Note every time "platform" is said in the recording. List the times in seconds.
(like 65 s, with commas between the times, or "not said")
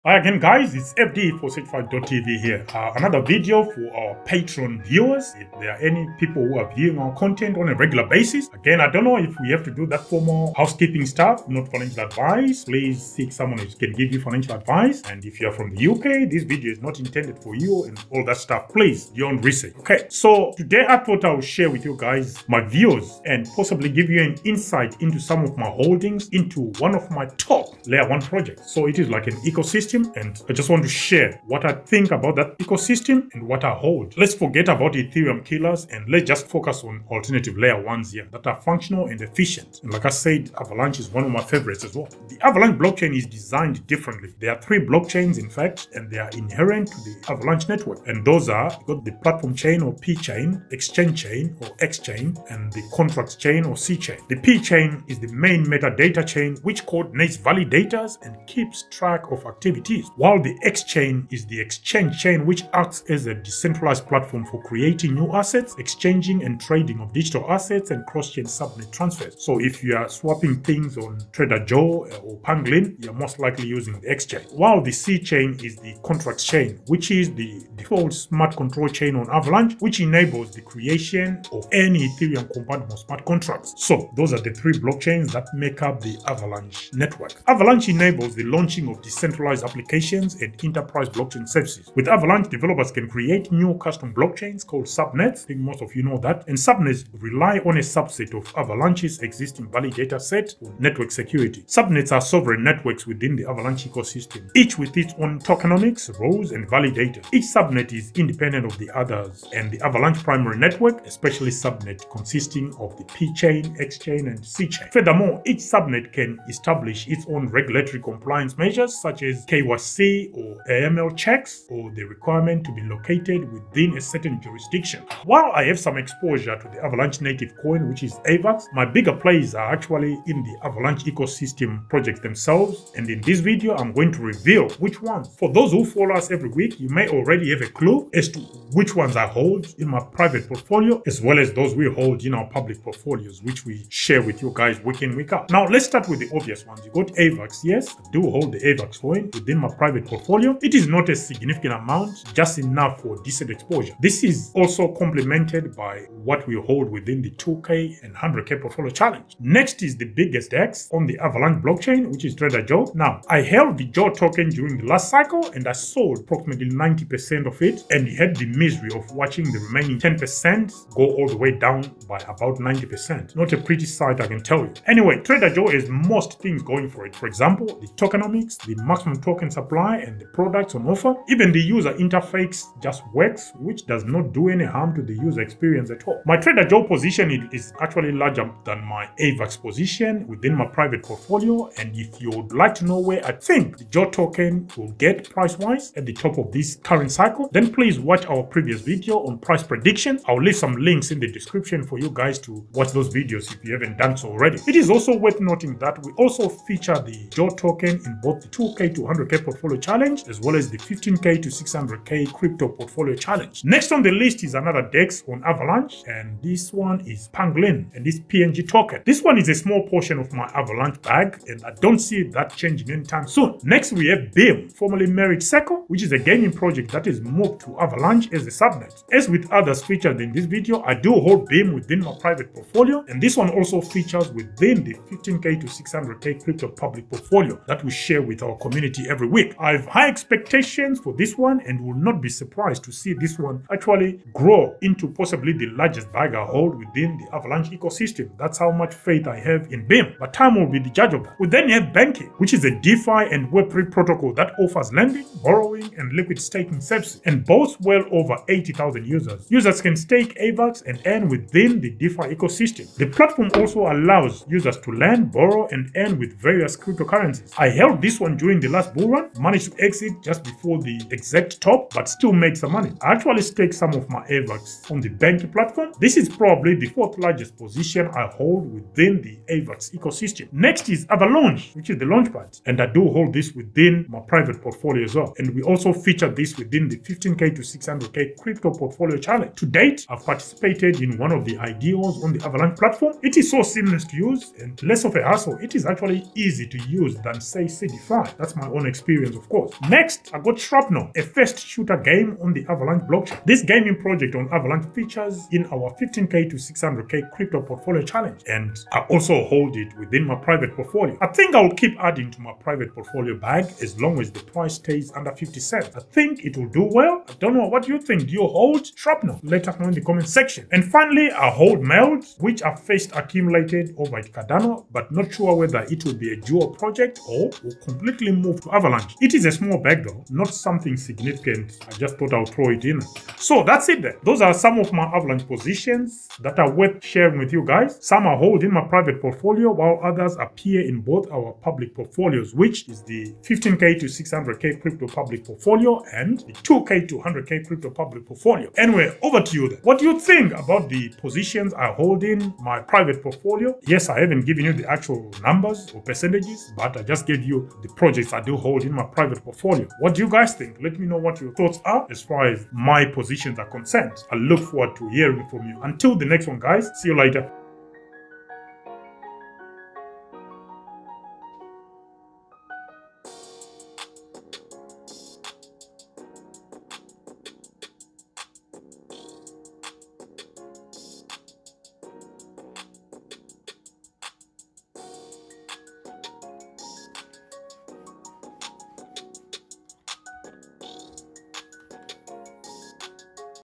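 49 s, 64 s, 263 s, 275 s, 292 s.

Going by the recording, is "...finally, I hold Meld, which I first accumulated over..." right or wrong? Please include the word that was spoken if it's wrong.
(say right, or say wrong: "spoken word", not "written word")
right.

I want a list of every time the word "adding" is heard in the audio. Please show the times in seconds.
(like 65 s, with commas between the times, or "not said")
312 s.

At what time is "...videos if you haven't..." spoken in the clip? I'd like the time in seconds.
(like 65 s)
203 s.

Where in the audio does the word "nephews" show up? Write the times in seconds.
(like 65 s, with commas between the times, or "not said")
not said.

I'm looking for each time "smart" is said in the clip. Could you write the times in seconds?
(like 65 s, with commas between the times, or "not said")
78 s, 82 s.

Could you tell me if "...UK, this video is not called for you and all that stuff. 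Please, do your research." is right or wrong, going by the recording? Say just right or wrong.
wrong.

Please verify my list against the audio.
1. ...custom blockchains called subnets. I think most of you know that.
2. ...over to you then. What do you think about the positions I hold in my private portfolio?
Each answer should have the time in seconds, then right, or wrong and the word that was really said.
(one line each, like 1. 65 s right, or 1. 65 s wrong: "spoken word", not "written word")
1. 93 s right
2. 349 s right.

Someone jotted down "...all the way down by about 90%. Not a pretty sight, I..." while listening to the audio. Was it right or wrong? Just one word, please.
right.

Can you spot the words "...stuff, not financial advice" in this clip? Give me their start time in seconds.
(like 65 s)
11 s.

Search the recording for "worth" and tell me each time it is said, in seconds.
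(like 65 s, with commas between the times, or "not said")
205 s, 336 s.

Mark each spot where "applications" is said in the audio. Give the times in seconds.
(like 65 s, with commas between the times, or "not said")
89 s.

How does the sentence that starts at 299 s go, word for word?
Next, I got Shrapnel, a first shooter game on the Avalanche blockchain.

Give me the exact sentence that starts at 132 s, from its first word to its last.
And in this video, I'm going to reveal which ones.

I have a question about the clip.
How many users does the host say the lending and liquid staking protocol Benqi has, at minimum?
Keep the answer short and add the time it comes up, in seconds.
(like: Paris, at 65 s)
80,000, at 258 s.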